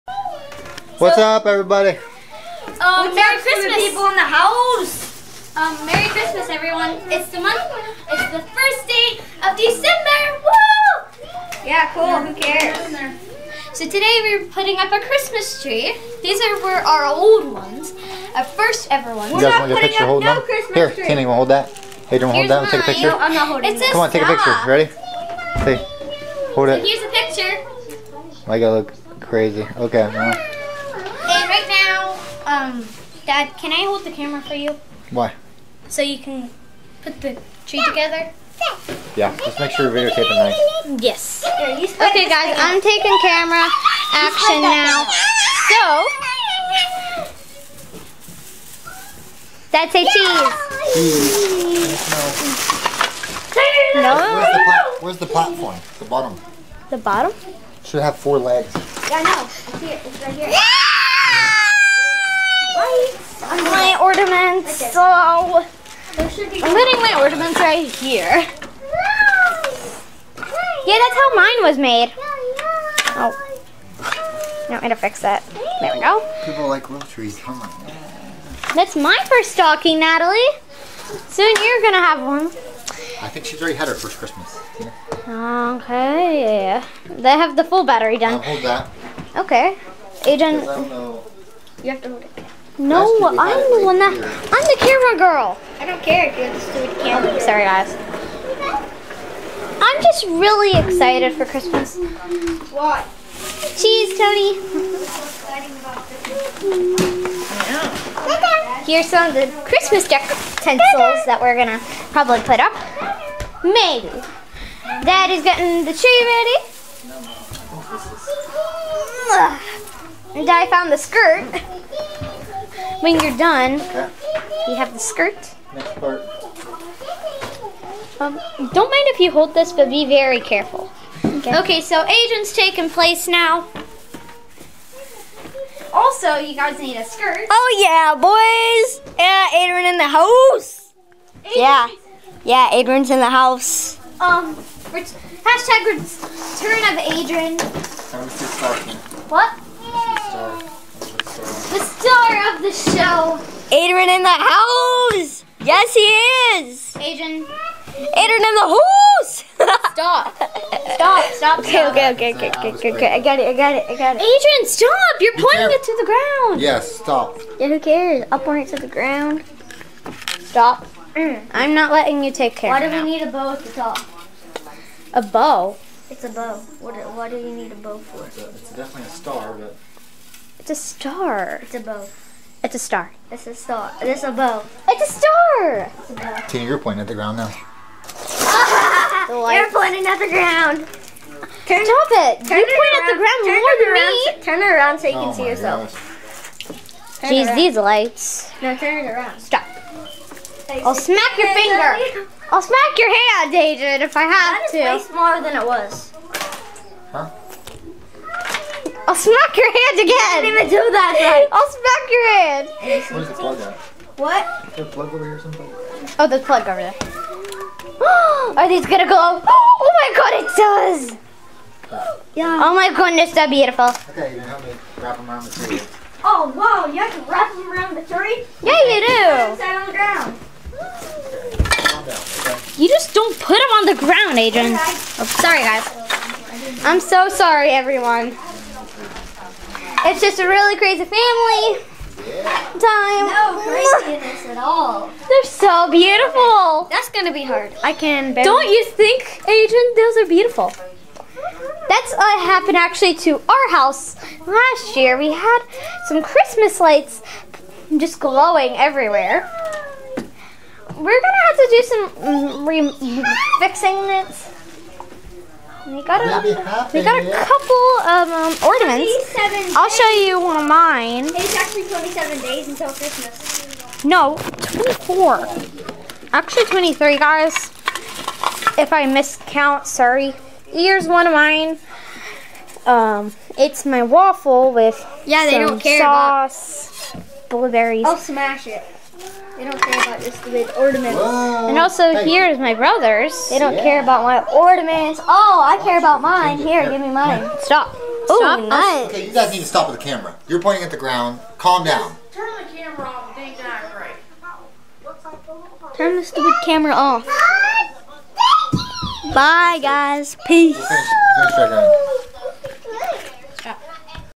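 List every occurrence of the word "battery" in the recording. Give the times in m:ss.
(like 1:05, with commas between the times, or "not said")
1:27.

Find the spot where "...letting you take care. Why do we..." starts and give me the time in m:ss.
2:51.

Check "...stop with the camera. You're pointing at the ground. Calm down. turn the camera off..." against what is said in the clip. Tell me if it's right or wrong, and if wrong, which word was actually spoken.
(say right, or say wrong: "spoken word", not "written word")
right.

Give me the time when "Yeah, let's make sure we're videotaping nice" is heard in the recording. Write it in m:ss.
0:39.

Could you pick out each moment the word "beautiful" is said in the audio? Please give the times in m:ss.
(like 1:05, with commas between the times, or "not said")
3:43, 4:05, 4:10.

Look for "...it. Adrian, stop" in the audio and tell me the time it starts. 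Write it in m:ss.
2:44.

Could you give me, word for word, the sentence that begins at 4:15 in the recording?
We had some Christmas lights just glowing everywhere.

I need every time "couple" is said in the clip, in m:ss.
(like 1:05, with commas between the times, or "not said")
4:27.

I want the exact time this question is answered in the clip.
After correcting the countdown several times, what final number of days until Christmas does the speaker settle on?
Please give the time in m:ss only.
4:36.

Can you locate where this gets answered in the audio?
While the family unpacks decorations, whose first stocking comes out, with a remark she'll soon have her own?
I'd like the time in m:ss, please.
1:19.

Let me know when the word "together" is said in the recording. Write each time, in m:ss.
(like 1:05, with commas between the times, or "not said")
0:37.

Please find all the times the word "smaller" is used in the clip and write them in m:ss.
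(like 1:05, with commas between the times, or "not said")
3:25.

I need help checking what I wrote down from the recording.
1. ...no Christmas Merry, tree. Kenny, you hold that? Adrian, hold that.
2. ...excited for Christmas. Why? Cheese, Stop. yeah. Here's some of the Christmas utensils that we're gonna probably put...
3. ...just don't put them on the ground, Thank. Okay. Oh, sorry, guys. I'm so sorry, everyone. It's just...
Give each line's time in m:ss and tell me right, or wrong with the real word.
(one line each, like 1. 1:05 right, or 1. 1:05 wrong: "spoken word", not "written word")
1. 0:20 wrong: "Here", not "Merry"
2. 1:40 wrong: "Tony", not "Stop"
3. 3:52 wrong: "Adrian", not "Thank".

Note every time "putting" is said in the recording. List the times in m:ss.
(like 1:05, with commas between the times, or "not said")
0:14, 1:06.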